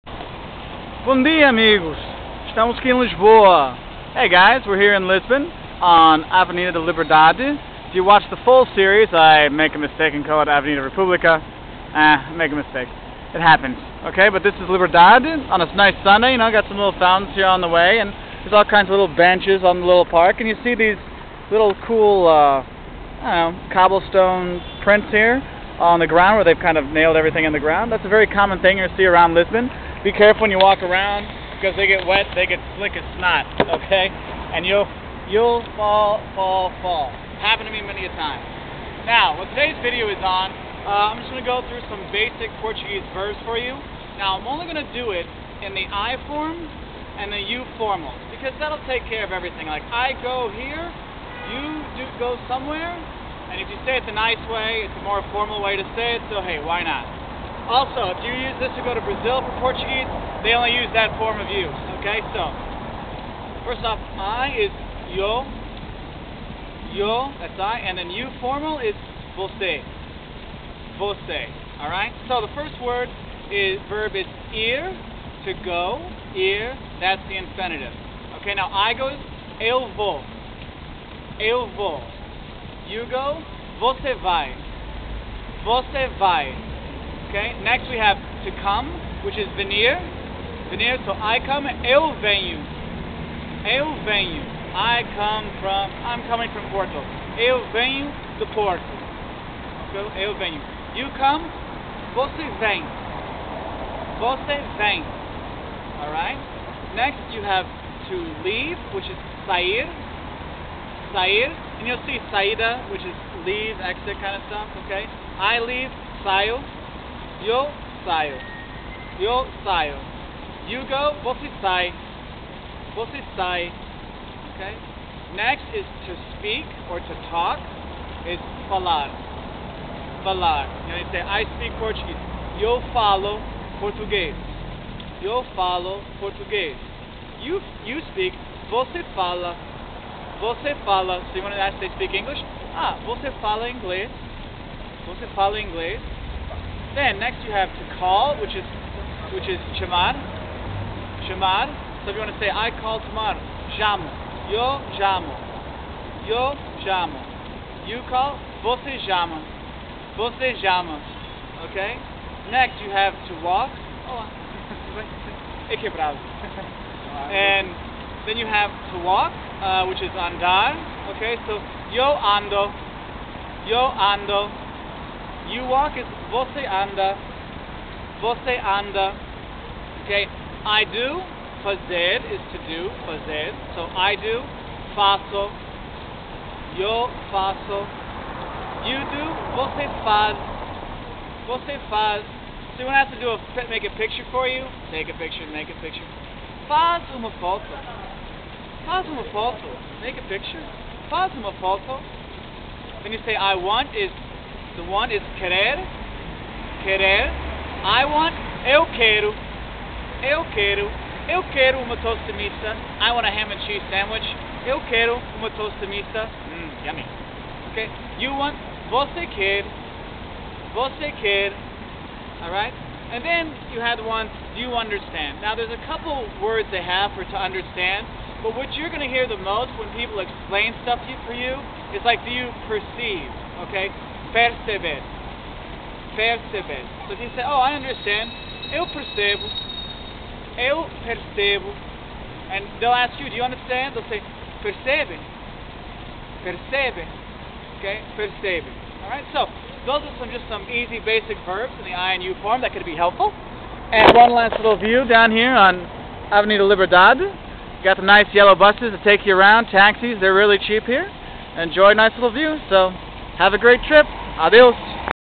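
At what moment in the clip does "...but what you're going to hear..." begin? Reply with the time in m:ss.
3:48.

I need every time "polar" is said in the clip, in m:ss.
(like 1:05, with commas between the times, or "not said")
not said.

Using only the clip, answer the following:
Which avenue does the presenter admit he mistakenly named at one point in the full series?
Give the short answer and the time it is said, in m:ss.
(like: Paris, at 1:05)
Avenida República, at 0:10.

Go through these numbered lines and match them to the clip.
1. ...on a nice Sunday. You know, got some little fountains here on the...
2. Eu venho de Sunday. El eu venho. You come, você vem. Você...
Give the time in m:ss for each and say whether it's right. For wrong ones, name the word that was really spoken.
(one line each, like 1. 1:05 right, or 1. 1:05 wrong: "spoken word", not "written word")
1. 0:15 right
2. 1:37 wrong: "Porto", not "Sunday".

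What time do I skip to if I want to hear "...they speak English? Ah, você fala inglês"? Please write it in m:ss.
2:21.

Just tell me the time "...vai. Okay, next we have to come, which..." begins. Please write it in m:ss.
1:26.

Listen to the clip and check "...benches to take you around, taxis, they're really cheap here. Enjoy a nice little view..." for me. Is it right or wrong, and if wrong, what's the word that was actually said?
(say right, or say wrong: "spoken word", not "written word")
wrong: "buses", not "benches".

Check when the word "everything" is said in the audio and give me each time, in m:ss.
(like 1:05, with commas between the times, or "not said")
0:27, 0:49.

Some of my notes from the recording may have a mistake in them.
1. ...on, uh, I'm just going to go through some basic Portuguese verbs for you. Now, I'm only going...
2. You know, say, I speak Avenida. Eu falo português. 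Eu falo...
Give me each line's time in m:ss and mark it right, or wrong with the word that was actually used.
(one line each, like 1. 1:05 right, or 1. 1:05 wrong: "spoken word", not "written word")
1. 0:40 right
2. 2:10 wrong: "Portuguese", not "Avenida".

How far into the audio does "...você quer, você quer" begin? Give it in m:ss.
3:38.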